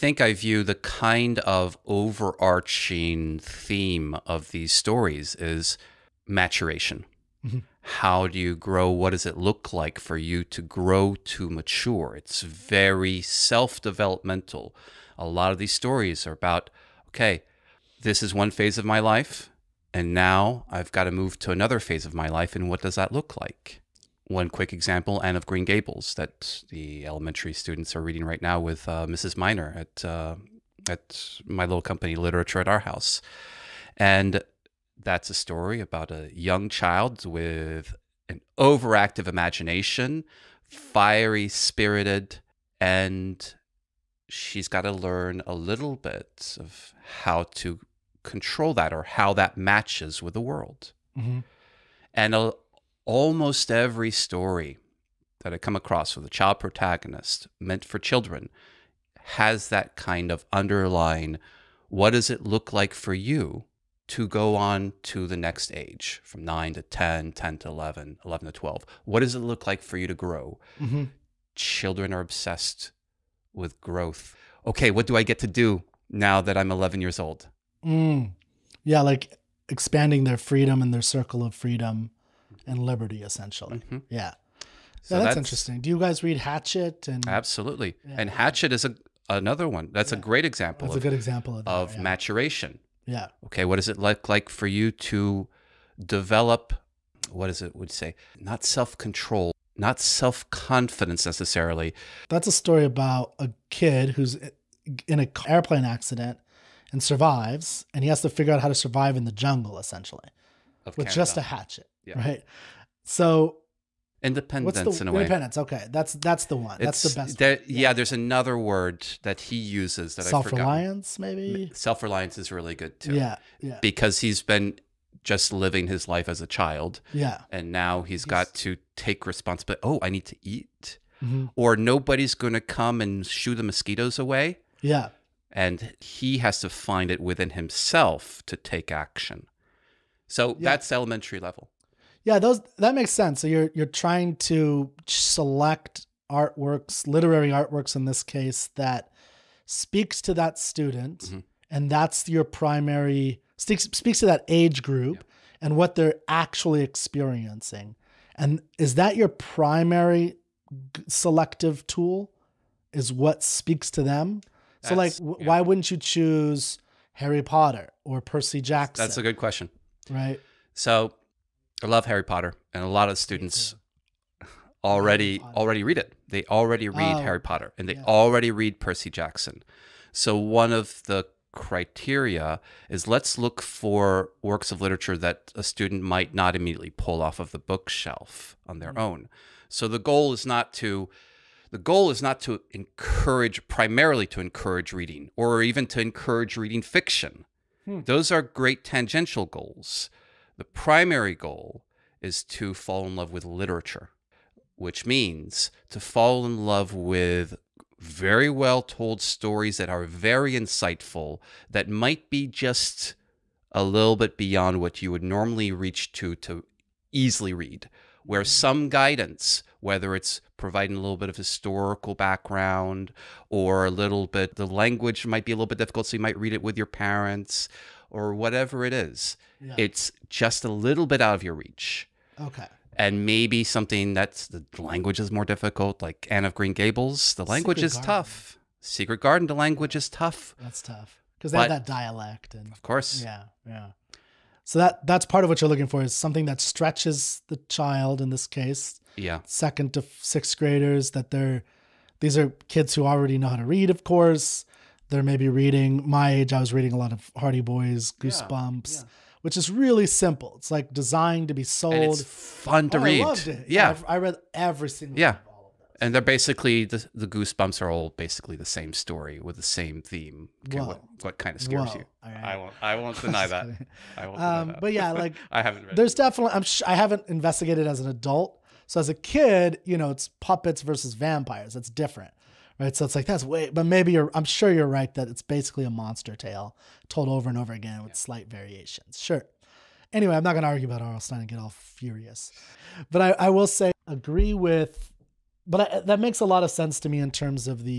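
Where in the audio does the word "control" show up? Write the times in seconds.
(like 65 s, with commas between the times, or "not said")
48 s, 98 s.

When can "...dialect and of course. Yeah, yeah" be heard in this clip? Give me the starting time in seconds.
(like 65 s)
241 s.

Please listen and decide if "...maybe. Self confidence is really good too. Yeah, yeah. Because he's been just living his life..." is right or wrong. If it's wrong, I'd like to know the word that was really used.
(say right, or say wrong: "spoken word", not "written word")
wrong: "reliance", not "confidence".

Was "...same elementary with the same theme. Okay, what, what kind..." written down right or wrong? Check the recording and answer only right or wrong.
wrong.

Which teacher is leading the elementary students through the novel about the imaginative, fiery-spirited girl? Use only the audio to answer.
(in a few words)
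Mrs Miner.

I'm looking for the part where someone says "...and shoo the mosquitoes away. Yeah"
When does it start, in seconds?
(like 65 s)
133 s.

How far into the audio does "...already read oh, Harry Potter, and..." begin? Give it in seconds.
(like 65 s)
176 s.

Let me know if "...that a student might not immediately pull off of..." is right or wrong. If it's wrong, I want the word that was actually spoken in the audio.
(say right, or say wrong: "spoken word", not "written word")
right.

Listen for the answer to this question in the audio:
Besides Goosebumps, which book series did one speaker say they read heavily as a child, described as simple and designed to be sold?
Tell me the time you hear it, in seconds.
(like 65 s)
257 s.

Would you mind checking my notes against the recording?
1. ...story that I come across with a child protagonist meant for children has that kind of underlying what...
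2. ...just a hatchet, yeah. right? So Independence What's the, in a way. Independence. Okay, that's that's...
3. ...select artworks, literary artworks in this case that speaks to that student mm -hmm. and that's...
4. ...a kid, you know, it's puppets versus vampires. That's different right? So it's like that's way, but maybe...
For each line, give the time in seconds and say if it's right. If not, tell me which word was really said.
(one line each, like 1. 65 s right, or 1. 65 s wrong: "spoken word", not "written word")
1. 54 s right
2. 111 s right
3. 145 s right
4. 279 s right.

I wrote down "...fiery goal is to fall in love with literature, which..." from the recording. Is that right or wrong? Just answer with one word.
wrong.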